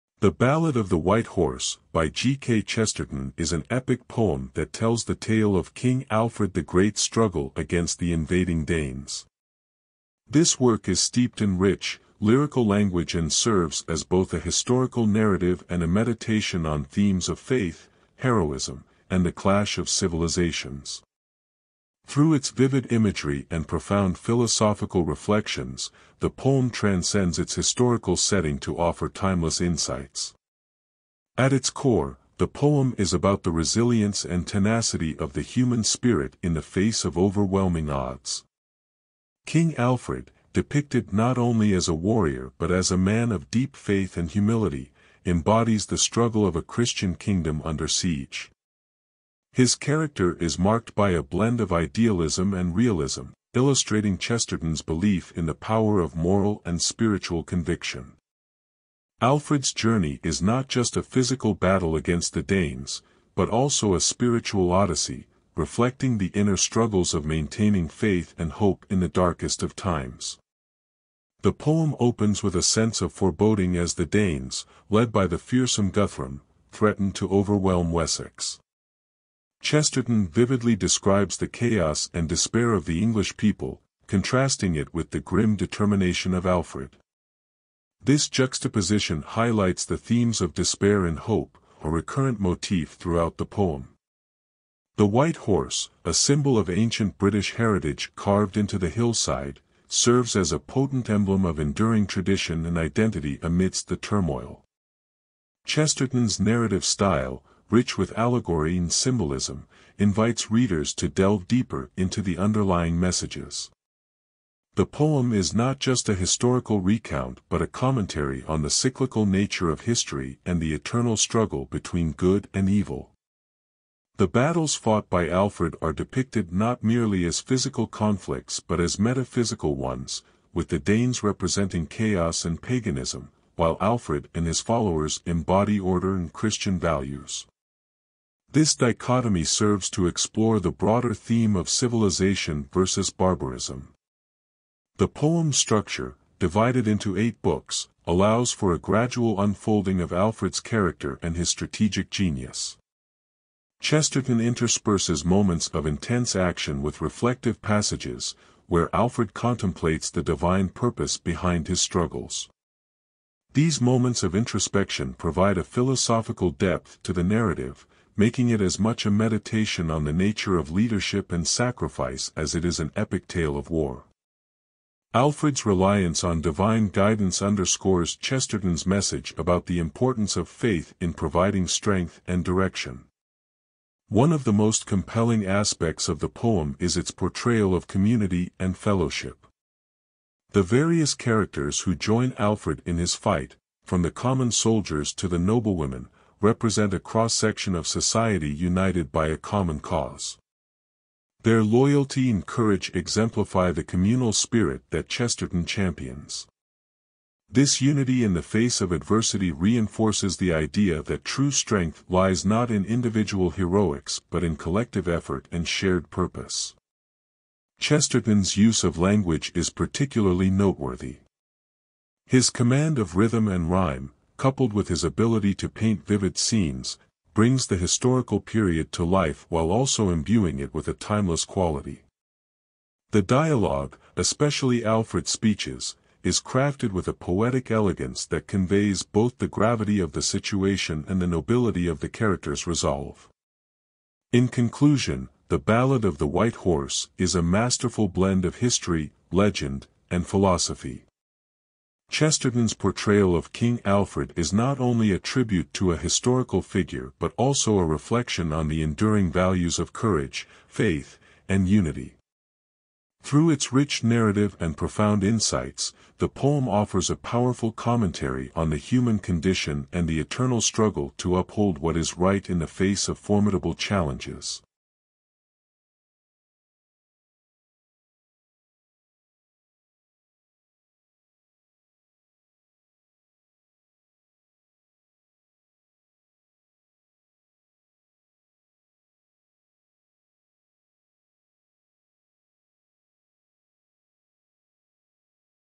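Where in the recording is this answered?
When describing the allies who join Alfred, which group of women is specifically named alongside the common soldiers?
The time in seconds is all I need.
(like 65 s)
195 s.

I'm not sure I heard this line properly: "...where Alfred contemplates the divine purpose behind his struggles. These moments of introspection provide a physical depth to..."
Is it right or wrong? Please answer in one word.
wrong.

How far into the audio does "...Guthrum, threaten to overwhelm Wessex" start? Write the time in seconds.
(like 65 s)
75 s.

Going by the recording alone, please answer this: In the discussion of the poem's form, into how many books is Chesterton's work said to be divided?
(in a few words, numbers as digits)
8.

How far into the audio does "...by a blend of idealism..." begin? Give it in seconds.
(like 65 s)
50 s.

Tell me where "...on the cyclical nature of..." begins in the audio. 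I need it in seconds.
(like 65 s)
118 s.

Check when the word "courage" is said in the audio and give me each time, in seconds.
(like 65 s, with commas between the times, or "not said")
202 s, 259 s.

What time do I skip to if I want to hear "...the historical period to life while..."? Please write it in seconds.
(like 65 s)
227 s.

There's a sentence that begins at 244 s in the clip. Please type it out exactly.
In conclusion, The Ballad of the White Horse is a masterful blend of history, legend, and philosophy.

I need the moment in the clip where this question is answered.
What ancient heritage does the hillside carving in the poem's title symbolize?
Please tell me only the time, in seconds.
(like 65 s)
96 s.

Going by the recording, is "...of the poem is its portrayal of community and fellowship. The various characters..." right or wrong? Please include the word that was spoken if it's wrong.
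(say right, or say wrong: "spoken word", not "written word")
right.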